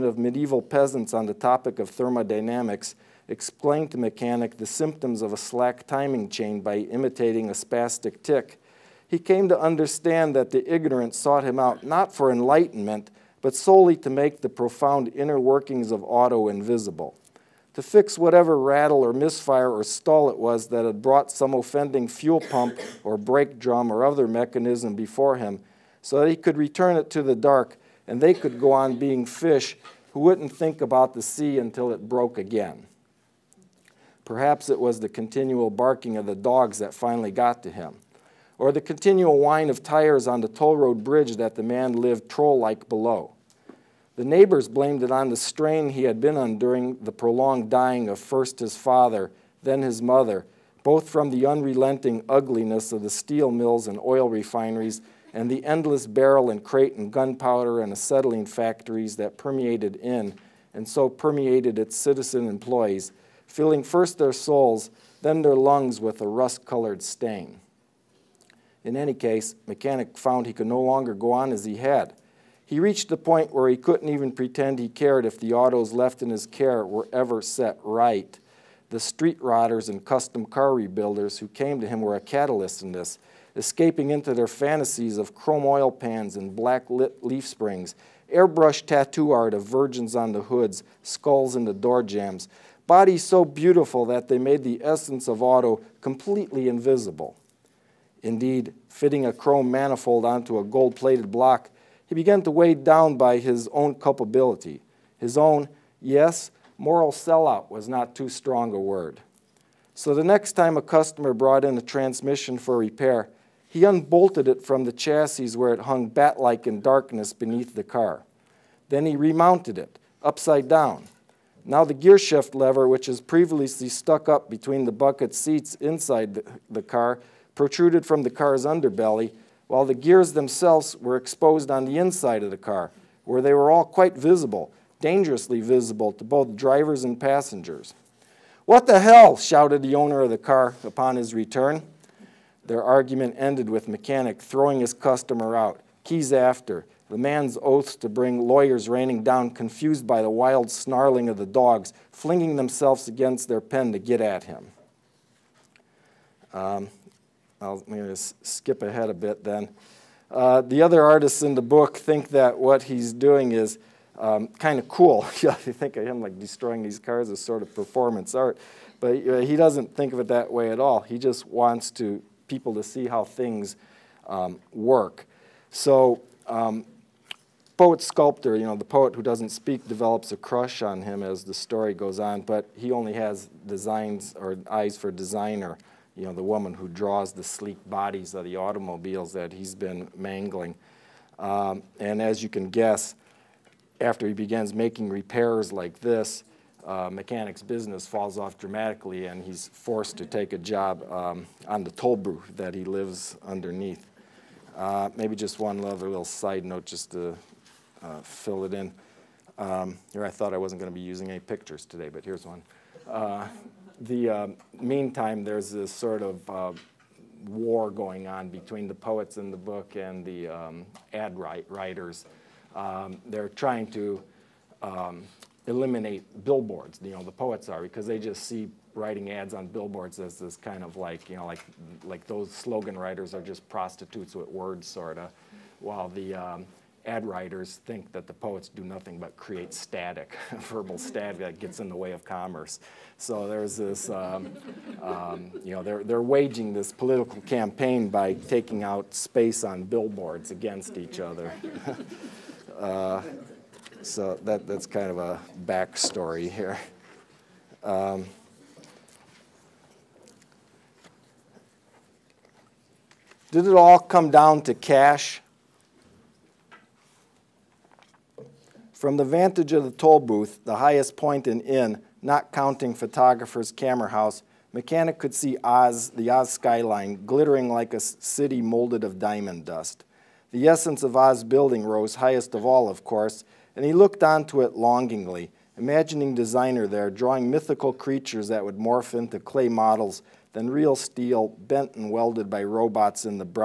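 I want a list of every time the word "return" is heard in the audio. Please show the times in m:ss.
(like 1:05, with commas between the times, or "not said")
0:26, 2:21.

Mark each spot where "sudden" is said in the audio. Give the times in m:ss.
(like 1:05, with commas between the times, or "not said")
not said.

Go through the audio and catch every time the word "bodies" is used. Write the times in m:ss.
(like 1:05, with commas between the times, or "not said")
1:32, 3:07.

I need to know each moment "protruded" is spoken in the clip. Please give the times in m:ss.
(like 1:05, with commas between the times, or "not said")
2:07.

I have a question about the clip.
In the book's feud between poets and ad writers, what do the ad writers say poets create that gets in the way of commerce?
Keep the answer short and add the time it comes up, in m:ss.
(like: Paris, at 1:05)
Verbal static, at 4:00.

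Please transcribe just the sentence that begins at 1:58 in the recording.
Then he remounted it, upside down.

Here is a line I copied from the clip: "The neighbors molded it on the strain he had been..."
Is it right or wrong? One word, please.
wrong.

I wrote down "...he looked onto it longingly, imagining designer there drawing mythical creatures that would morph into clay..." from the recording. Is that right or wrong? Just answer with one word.
right.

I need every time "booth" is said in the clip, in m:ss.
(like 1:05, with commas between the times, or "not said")
3:22, 4:30.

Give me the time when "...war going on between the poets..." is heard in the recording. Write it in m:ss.
3:37.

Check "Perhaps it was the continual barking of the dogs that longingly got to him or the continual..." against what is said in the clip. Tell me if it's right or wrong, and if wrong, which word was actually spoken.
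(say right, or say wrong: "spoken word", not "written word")
wrong: "finally", not "longingly".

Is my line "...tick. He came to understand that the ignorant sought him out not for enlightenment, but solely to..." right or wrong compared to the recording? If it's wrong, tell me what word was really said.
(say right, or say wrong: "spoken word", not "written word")
right.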